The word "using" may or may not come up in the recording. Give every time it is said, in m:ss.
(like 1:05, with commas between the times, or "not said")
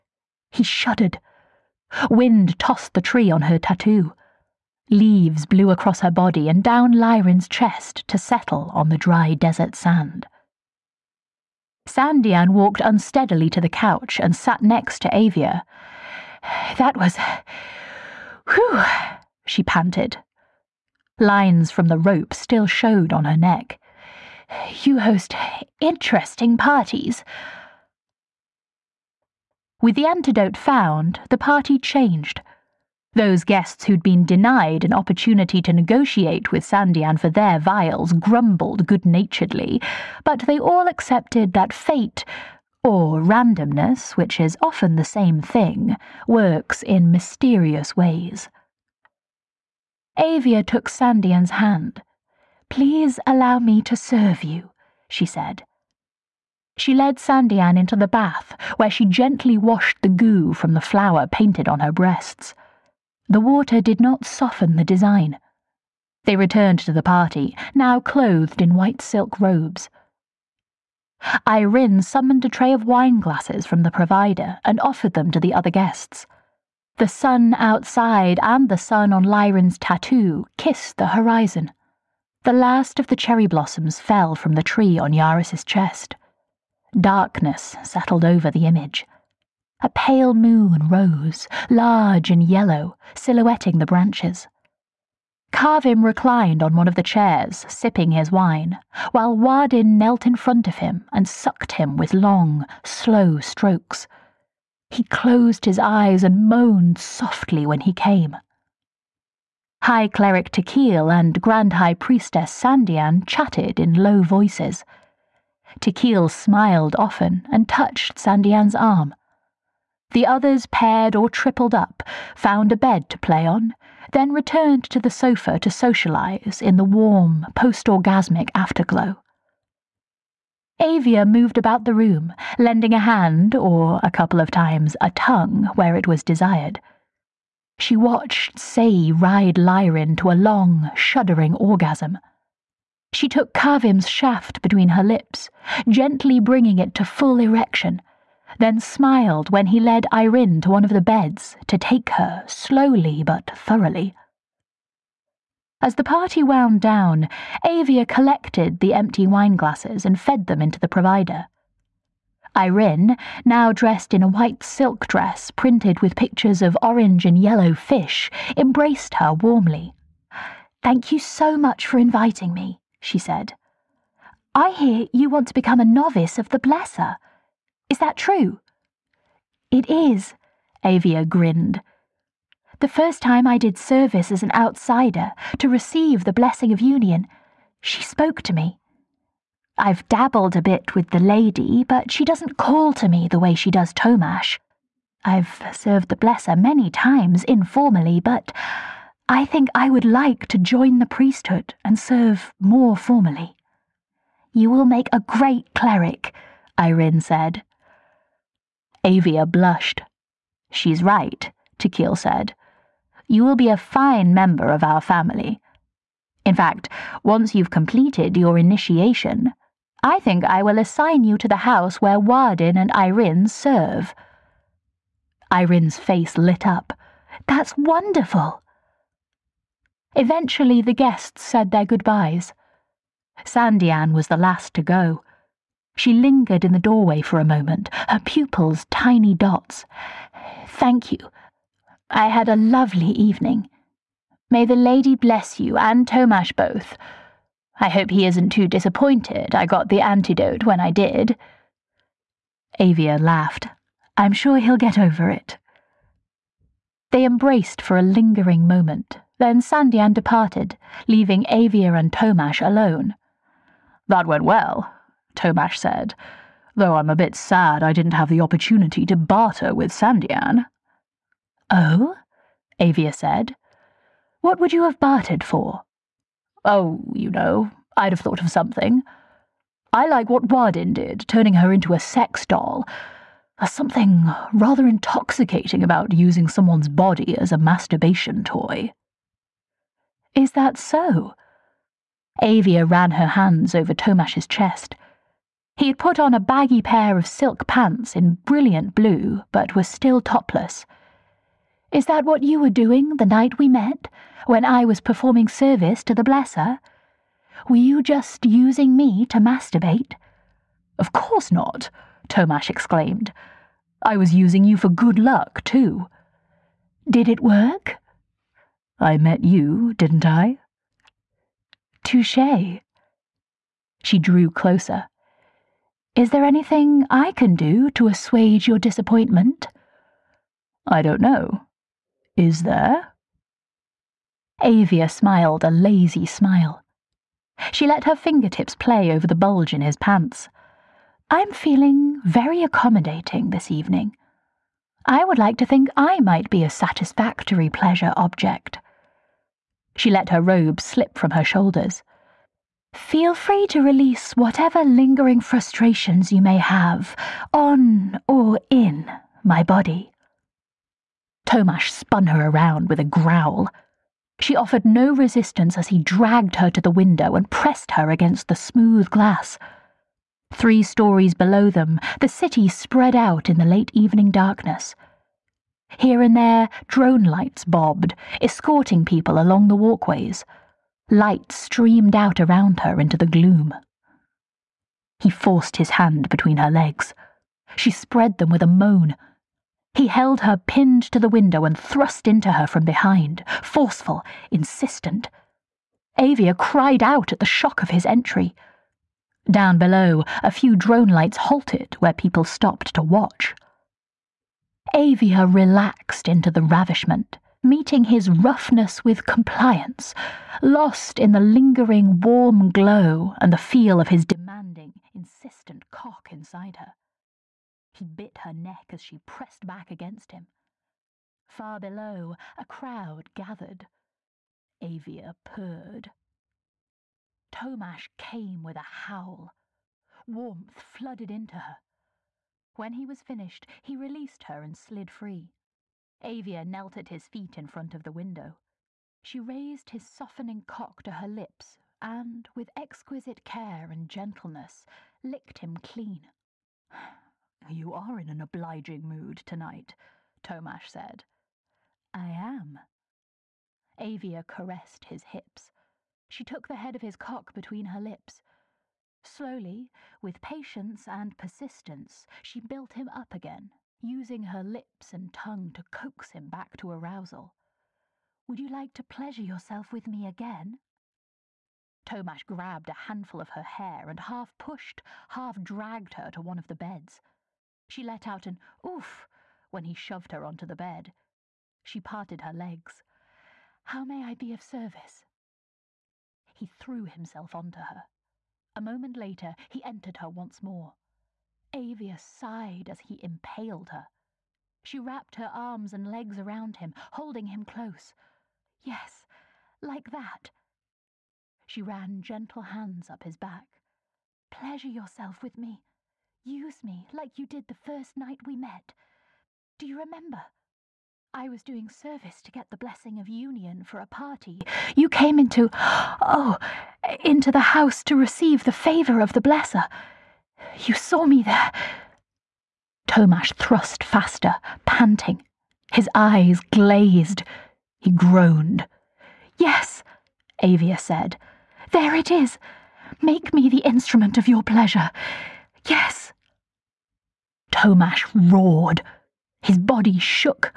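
4:46, 5:08, 5:14, 7:44.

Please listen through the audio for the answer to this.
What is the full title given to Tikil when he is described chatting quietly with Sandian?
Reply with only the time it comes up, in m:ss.
1:49.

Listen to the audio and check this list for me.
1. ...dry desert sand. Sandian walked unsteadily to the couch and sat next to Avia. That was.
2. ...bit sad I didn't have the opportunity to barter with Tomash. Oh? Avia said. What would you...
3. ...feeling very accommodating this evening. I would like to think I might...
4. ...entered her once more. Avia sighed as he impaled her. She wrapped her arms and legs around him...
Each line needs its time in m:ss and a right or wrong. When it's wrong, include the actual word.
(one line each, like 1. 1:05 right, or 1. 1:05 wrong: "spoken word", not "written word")
1. 0:08 right
2. 4:27 wrong: "Sandian", not "Tomash"
3. 5:41 right
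4. 8:09 right.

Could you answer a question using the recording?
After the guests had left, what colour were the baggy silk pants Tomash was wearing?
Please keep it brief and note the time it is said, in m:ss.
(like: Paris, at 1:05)
brilliant blue, at 4:58.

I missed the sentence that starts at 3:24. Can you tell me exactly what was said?
You will make a great cleric, Irene said.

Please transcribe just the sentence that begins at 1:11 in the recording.
Irene summoned a tray of wine glasses from the provider and offered them to the other guests.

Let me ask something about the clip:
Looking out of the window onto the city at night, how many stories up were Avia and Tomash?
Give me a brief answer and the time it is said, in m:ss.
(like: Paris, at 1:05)
3, at 6:10.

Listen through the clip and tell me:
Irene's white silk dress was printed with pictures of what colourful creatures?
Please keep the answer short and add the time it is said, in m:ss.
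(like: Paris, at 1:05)
orange and yellow fish, at 2:46.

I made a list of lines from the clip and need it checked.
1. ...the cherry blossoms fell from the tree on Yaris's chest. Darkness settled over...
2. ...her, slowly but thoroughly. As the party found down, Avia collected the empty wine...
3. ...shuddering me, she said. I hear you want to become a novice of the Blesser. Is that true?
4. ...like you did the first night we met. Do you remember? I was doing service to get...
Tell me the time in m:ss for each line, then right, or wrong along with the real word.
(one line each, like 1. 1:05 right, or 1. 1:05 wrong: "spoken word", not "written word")
1. 1:23 right
2. 2:32 wrong: "wound", not "found"
3. 2:51 wrong: "inviting", not "shuddering"
4. 8:27 right.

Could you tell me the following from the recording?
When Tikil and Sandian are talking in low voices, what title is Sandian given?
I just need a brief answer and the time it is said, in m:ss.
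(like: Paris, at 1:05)
Grand High Priestess, at 1:51.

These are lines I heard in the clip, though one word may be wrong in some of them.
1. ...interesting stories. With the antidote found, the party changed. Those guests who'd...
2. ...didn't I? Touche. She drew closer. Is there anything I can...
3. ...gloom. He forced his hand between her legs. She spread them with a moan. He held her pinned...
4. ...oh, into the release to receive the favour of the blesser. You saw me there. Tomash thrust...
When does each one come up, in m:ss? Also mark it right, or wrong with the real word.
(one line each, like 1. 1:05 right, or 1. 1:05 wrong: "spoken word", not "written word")
1. 0:25 wrong: "parties", not "stories"
2. 5:19 right
3. 6:23 right
4. 8:35 wrong: "house", not "release".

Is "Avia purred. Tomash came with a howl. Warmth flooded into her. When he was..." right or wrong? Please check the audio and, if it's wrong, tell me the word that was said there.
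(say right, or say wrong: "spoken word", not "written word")
right.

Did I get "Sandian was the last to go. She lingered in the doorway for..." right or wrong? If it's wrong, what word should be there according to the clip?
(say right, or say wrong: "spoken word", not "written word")
right.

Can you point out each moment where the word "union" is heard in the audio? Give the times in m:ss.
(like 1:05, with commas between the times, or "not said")
3:06, 8:33.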